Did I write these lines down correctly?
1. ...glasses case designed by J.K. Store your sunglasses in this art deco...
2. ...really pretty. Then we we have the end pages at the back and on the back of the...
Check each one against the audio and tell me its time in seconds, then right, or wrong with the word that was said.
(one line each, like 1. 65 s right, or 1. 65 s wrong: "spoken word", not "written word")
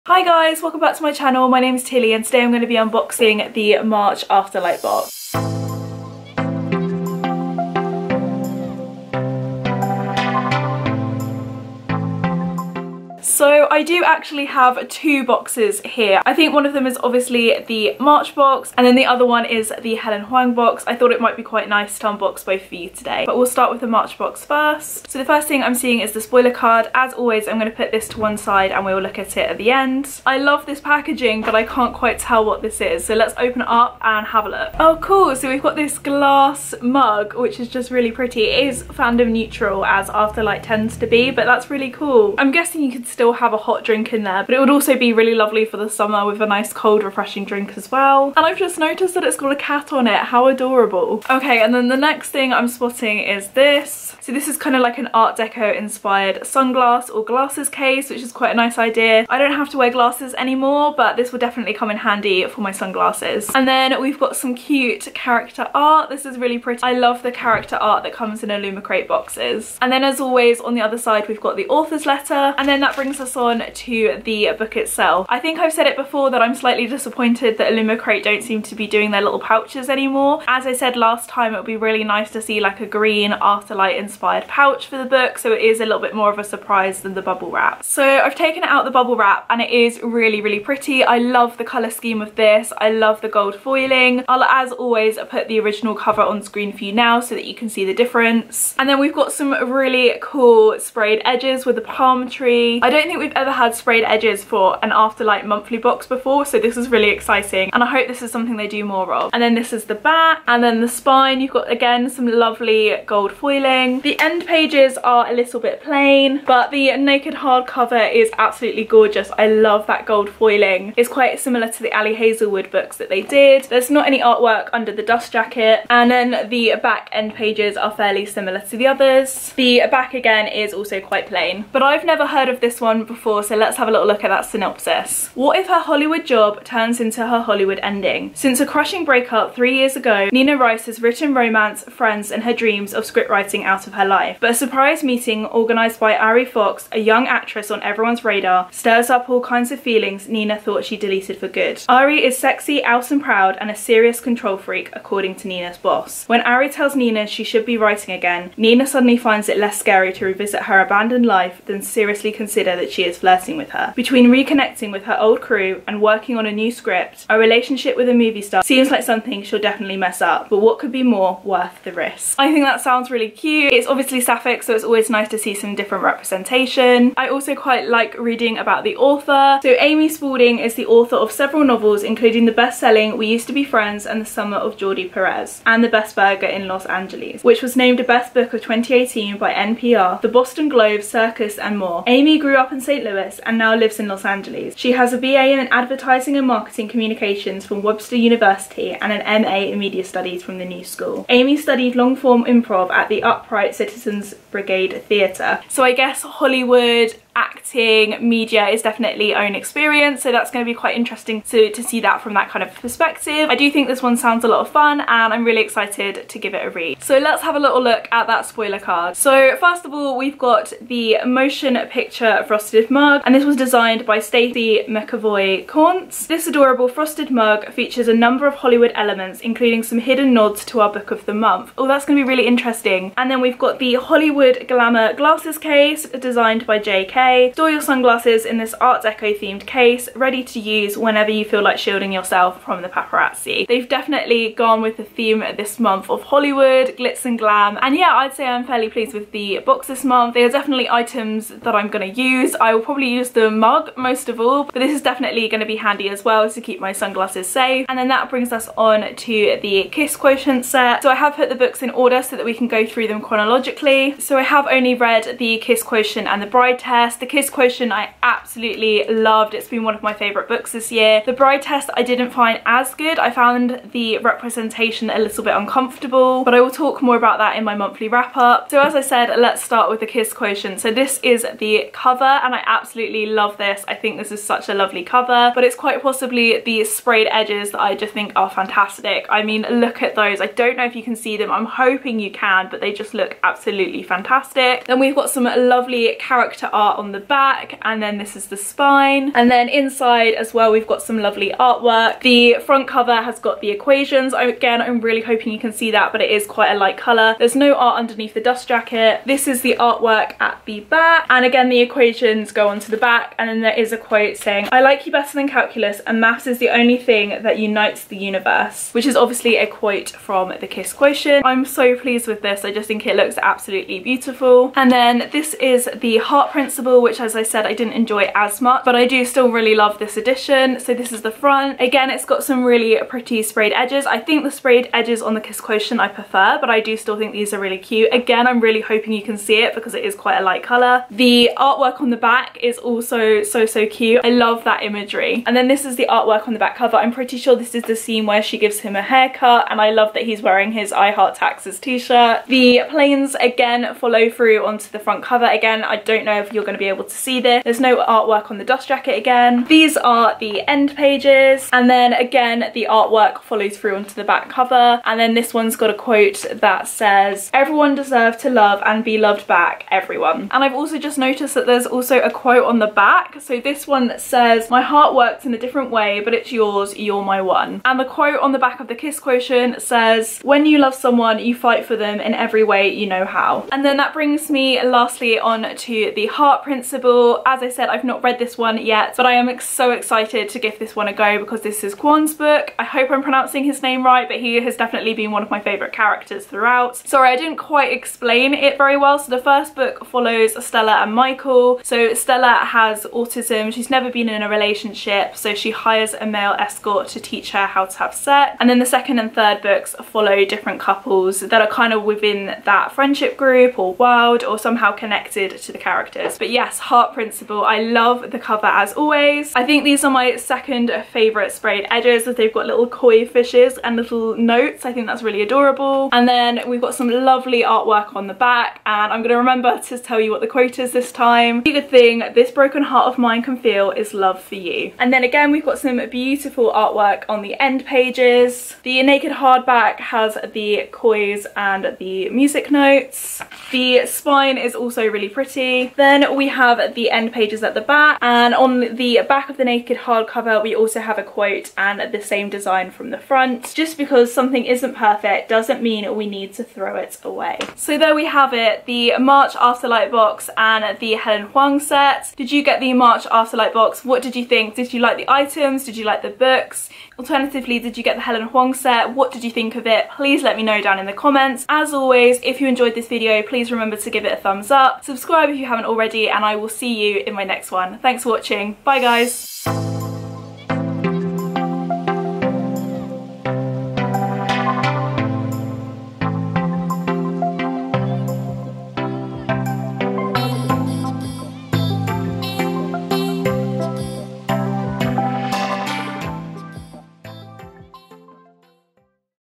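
1. 235 s right
2. 445 s right.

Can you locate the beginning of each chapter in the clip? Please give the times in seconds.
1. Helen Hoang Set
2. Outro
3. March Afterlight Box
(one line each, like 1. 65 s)
1. 258 s
2. 458 s
3. 22 s.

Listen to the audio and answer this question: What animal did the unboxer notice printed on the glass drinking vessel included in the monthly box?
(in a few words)
Cat.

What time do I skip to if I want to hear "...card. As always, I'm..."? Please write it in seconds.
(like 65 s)
26 s.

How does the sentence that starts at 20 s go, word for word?
I thought it might be quite nice to unbox both for you today.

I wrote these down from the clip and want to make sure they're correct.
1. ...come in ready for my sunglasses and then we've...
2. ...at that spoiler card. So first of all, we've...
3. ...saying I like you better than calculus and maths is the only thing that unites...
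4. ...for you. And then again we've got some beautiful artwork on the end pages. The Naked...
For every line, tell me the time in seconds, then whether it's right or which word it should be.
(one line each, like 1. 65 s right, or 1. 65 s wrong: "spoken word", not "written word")
1. 61 s wrong: "handy", not "ready"
2. 218 s right
3. 314 s right
4. 434 s right.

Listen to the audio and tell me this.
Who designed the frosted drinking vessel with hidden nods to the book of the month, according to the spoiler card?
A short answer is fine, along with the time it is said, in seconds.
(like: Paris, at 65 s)
Stacey McAvoy Corntz, at 224 s.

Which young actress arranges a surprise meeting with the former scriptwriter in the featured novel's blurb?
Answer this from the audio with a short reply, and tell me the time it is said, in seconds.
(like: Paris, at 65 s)
Ari Fox, at 146 s.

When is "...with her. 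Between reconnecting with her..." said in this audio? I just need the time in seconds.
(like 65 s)
163 s.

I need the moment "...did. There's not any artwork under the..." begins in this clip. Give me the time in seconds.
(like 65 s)
123 s.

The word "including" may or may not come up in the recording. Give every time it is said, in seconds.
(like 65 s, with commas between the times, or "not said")
182 s, 229 s.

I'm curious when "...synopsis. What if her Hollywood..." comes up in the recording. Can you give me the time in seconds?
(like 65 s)
134 s.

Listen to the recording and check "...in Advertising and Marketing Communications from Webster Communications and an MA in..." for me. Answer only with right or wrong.
wrong.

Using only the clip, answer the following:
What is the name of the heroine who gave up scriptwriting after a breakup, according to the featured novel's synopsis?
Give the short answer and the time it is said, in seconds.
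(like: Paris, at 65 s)
Nina Rice, at 140 s.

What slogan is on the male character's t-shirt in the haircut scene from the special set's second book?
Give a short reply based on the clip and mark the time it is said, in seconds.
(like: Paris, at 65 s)
I Heart Taxes, at 350 s.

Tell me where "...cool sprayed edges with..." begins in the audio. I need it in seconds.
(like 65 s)
100 s.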